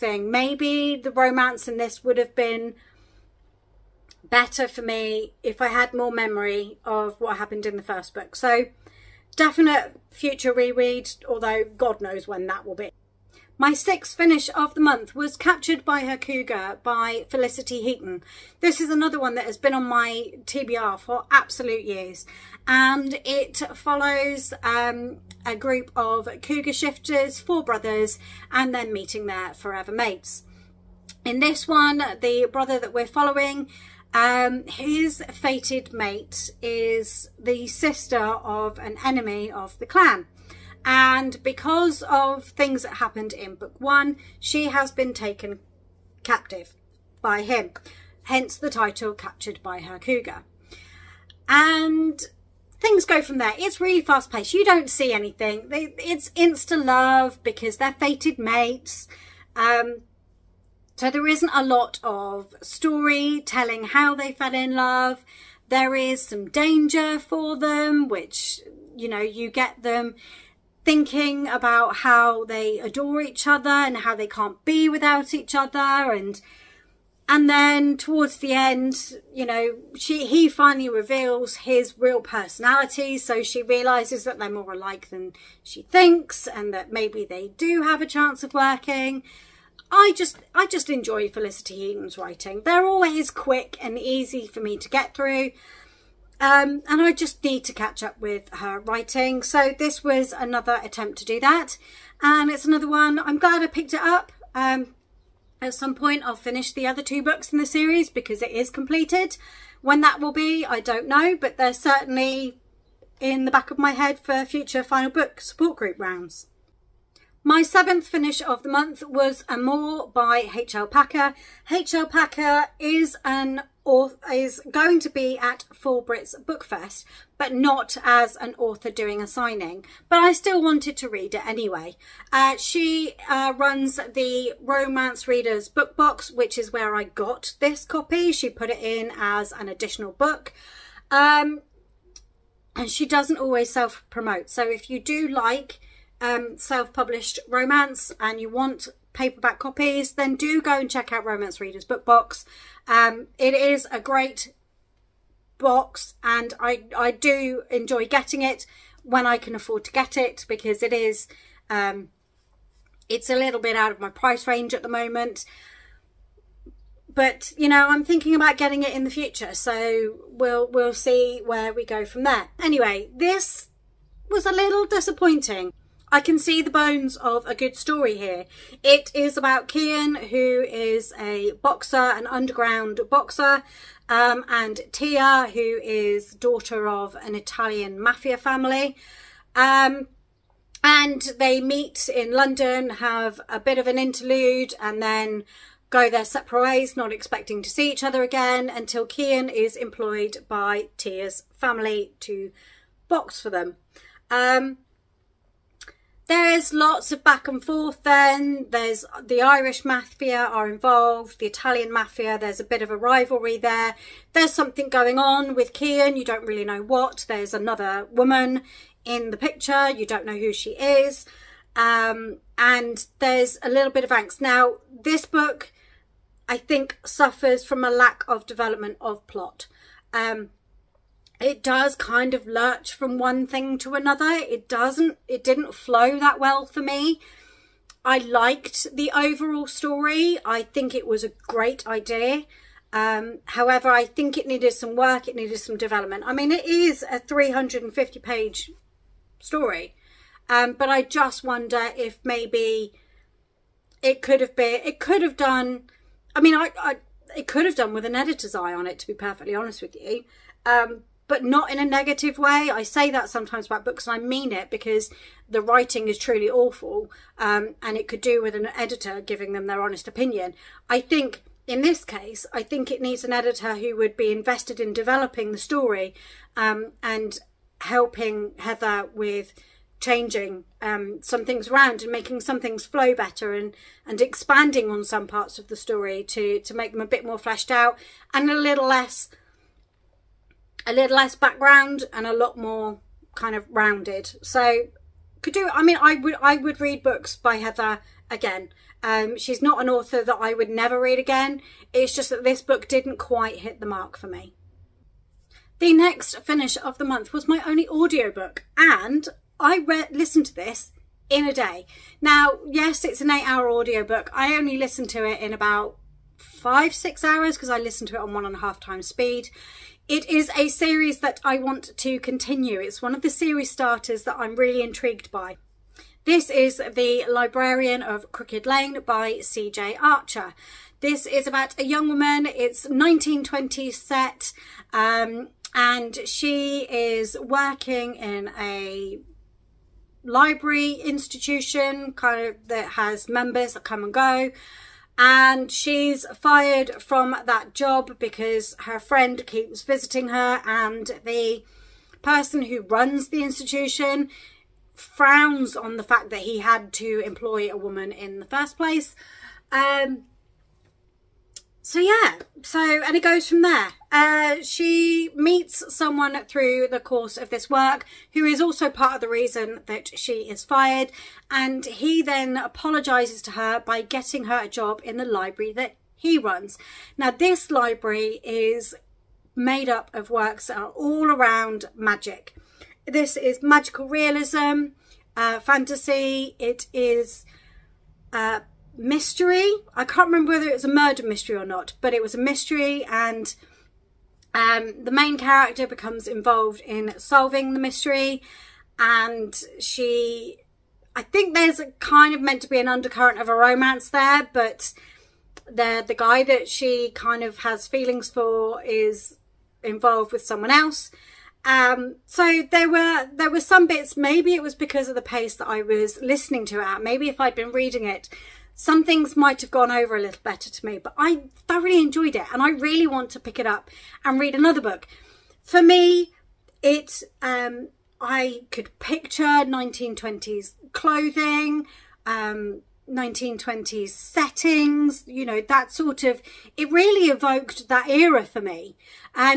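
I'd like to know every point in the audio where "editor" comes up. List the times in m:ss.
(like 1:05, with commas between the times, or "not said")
4:18, 4:28, 4:33.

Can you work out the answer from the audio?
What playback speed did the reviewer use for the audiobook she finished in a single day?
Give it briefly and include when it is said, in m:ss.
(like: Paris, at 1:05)
1.5 times speed, at 5:18.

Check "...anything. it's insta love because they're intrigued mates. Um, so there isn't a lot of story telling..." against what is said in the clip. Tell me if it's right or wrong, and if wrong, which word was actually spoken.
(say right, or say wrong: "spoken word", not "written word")
wrong: "fated", not "intrigued".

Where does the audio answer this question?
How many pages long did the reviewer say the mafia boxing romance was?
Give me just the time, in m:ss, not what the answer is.
4:07.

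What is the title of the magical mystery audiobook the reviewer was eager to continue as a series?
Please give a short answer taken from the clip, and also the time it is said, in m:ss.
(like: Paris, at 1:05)
The Librarian of Crooked Lane, at 5:26.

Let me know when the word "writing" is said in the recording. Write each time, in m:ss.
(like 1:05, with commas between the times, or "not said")
1:32, 1:38, 4:25.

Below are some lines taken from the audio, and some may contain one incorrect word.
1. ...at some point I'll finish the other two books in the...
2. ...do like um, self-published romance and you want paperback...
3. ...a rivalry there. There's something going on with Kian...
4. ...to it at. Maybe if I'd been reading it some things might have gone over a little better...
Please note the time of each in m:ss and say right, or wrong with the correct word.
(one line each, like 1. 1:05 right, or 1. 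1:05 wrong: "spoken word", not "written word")
1. 1:45 right
2. 2:24 right
3. 3:32 right
4. 6:56 right.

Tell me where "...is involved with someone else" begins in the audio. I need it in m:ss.
6:48.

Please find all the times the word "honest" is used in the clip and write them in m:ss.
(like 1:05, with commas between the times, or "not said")
4:19, 4:29.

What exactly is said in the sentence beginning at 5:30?
This is about a young woman.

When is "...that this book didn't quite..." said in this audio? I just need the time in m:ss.
5:02.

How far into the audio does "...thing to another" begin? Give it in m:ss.
3:53.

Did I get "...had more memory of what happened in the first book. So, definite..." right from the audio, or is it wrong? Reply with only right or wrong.
right.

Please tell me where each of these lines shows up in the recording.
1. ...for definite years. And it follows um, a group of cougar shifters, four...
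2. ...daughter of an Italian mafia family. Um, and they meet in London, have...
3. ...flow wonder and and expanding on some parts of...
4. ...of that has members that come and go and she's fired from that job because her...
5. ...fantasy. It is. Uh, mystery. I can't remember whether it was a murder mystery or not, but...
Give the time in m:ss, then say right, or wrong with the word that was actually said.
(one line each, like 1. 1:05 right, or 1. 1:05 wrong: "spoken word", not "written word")
1. 0:20 wrong: "absolute", not "definite"
2. 3:06 right
3. 4:42 wrong: "better", not "wonder"
4. 5:42 right
5. 6:25 right.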